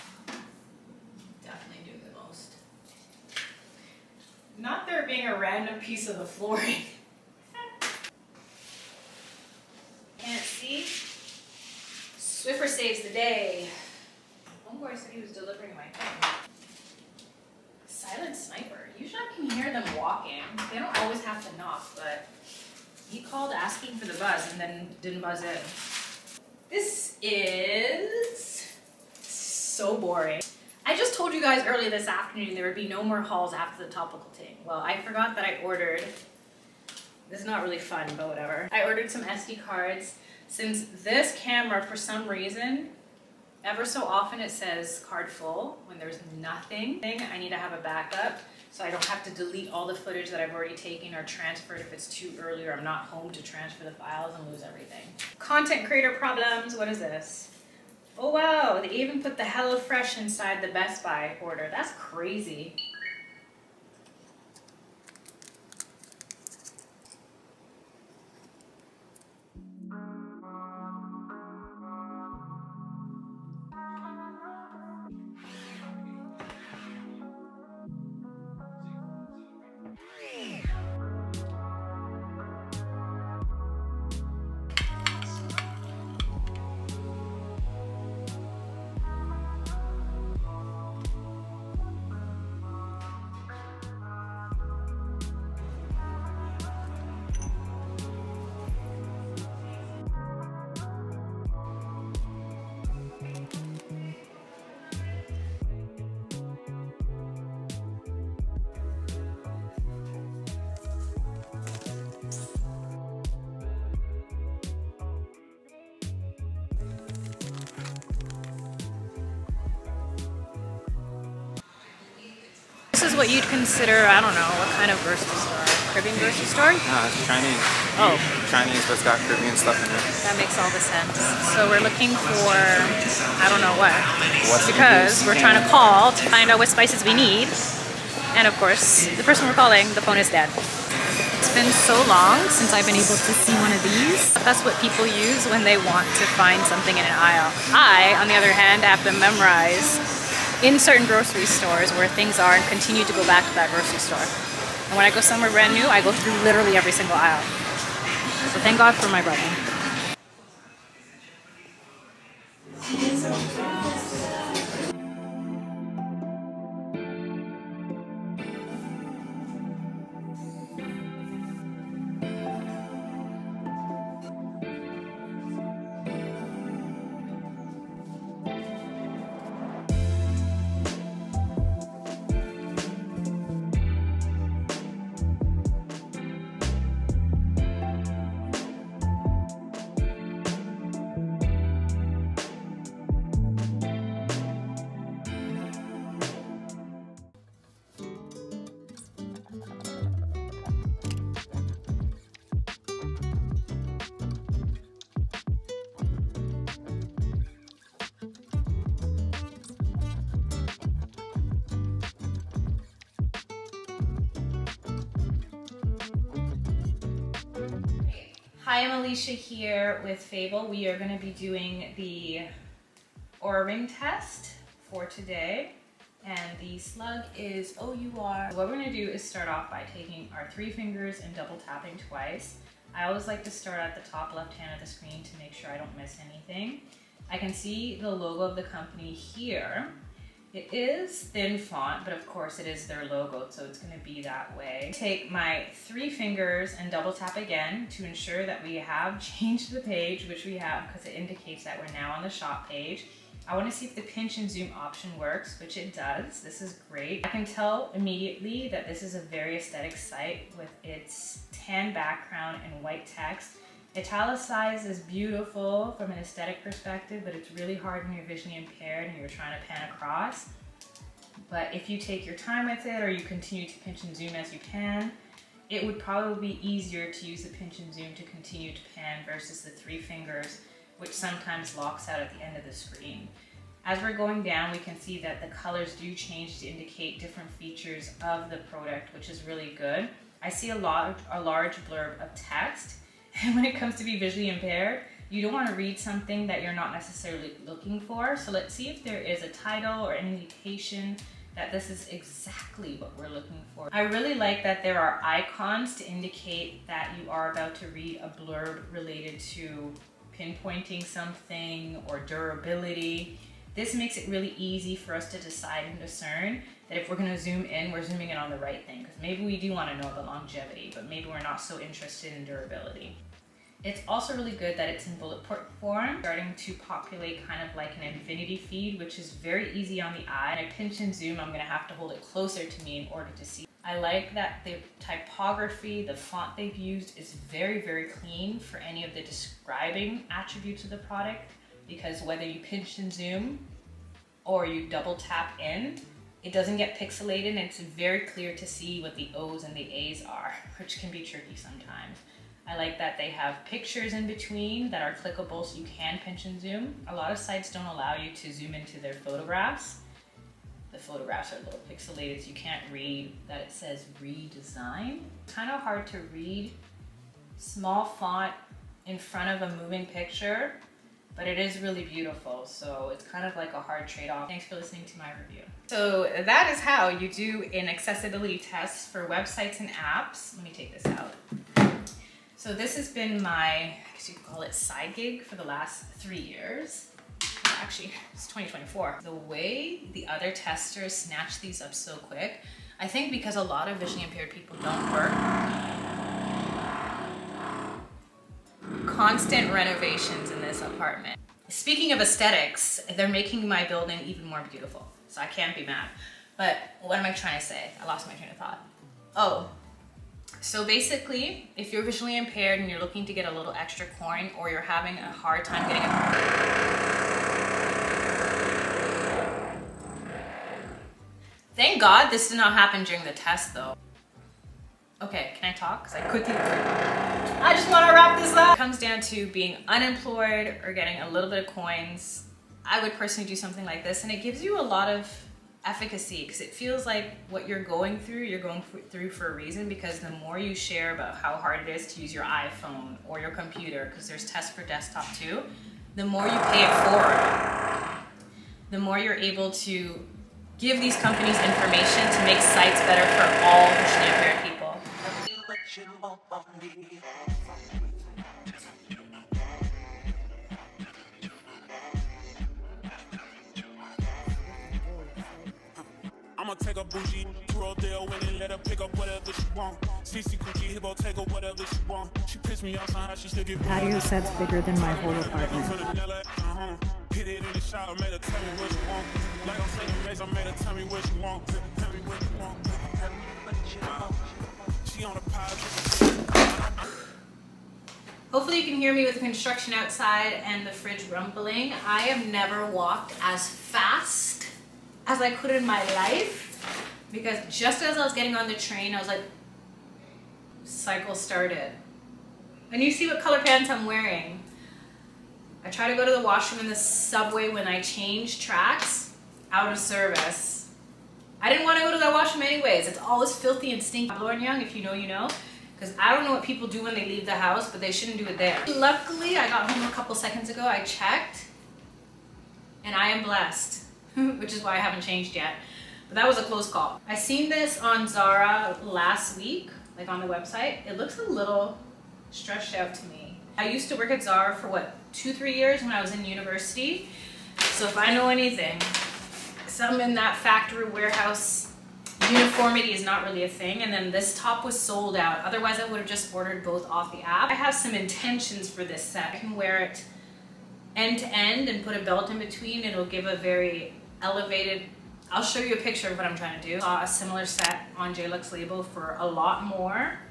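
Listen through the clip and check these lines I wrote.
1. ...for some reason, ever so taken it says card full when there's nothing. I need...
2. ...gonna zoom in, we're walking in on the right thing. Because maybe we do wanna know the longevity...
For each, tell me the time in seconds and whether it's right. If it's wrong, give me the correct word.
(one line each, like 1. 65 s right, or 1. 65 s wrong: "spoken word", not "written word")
1. 41 s wrong: "often", not "taken"
2. 317 s wrong: "zooming", not "walking".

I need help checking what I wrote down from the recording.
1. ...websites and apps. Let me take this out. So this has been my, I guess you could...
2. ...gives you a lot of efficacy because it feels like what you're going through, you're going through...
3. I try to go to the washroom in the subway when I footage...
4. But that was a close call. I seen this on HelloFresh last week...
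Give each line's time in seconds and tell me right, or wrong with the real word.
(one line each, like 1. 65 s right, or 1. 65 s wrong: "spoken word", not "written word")
1. 379 s right
2. 434 s right
3. 505 s wrong: "change", not "footage"
4. 526 s wrong: "Zara", not "HelloFresh".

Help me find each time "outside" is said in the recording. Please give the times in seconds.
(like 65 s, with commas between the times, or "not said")
489 s.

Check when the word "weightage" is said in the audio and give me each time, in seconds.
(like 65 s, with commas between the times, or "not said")
not said.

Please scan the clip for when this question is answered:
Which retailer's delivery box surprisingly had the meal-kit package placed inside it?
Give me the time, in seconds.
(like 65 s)
60 s.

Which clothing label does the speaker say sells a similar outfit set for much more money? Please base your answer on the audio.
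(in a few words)
Jay Lux.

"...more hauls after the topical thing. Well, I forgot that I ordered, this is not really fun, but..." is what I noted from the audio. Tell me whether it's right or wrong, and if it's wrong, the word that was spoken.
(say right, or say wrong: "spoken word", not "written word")
right.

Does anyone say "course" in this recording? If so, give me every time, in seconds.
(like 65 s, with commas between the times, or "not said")
138 s, 242 s.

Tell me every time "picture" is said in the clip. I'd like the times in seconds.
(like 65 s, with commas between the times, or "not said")
353 s, 370 s, 555 s.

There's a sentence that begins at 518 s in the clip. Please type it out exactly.
Luckily, I got home a couple seconds ago.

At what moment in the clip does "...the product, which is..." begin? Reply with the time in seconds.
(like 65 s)
288 s.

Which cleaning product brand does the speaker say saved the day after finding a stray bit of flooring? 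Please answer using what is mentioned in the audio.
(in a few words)
Swiffer.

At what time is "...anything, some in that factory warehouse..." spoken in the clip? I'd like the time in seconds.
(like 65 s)
538 s.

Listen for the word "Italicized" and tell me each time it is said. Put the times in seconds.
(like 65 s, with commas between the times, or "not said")
263 s.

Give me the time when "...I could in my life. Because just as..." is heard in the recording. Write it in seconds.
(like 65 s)
495 s.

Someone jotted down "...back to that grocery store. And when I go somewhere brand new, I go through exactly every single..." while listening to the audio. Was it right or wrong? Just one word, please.
wrong.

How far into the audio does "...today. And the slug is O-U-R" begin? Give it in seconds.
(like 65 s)
225 s.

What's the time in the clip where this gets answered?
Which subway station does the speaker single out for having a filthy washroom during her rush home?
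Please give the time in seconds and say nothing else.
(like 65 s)
514 s.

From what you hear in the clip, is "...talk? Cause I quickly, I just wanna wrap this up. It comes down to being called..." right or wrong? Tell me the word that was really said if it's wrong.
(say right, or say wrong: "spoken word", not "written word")
wrong: "unemployed", not "called".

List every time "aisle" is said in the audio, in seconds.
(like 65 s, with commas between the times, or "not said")
147 s, 157 s.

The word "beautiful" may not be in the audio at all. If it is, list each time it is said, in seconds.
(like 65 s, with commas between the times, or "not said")
264 s, 372 s, 404 s.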